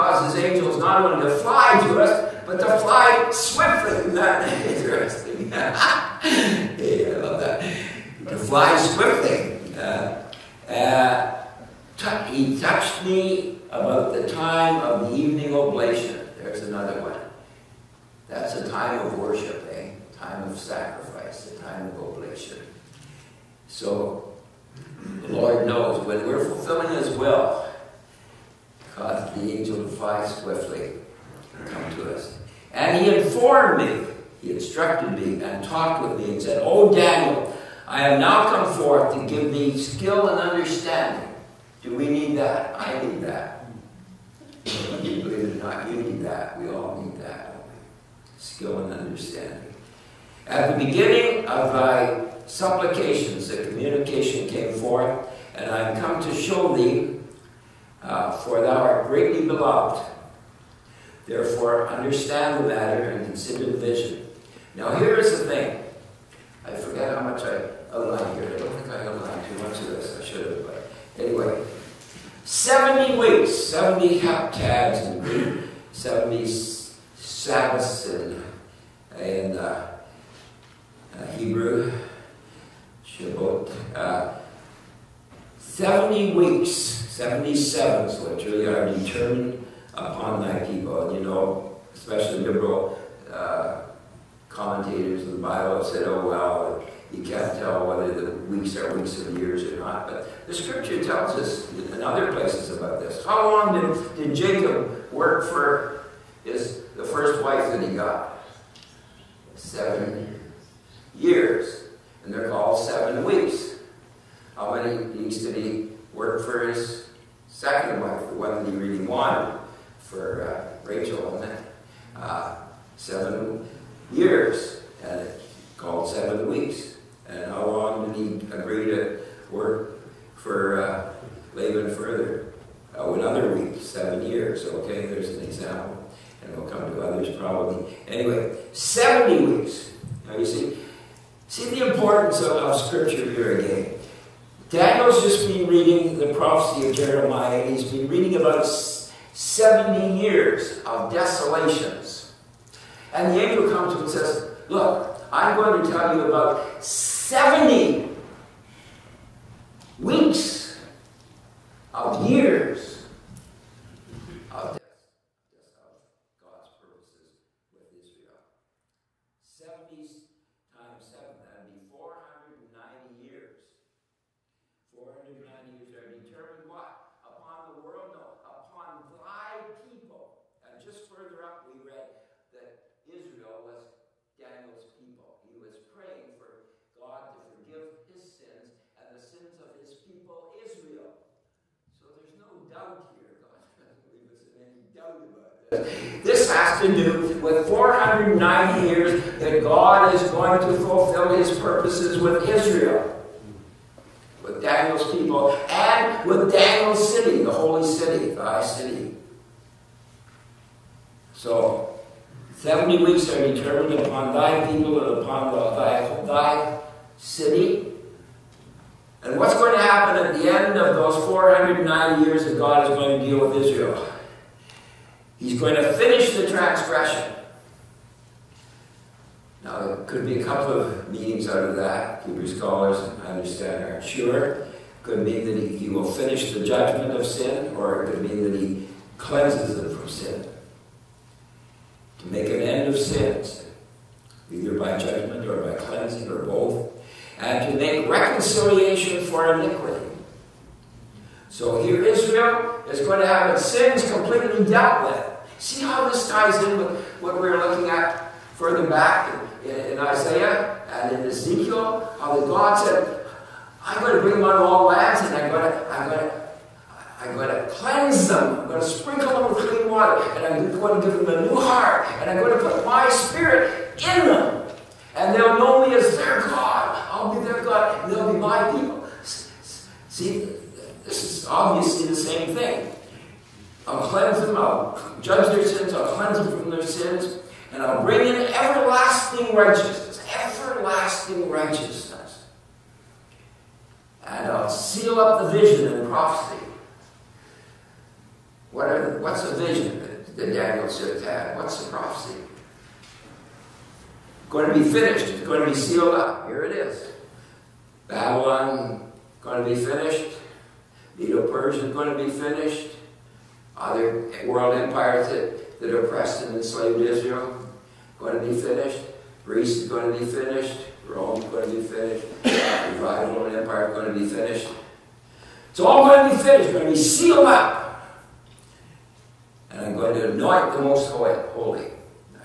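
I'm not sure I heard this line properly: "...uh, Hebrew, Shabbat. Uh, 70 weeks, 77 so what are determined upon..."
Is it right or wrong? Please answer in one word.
right.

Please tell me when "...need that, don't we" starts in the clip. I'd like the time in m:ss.
0:47.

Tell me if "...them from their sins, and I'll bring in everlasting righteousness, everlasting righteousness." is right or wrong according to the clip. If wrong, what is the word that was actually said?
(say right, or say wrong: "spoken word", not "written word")
right.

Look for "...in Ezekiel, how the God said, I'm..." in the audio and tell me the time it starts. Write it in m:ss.
4:21.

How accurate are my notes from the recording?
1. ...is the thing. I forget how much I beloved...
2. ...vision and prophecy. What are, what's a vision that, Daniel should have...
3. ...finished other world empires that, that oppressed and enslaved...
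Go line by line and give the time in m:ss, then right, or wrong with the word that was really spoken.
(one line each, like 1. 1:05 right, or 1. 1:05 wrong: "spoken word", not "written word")
1. 1:05 wrong: "outlined", not "beloved"
2. 4:55 right
3. 5:12 right.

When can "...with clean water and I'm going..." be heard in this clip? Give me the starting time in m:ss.
4:29.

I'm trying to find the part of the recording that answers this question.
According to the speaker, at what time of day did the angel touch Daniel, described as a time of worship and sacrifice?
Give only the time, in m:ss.
0:15.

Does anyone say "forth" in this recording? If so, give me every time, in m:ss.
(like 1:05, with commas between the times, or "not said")
0:38, 0:54.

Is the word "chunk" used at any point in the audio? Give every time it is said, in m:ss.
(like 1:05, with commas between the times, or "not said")
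not said.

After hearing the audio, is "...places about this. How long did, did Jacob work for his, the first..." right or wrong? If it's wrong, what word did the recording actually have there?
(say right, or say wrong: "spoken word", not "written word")
right.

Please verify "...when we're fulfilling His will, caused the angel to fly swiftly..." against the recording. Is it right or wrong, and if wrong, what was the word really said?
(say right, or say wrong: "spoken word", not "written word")
right.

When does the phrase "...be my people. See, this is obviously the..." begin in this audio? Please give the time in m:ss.
4:38.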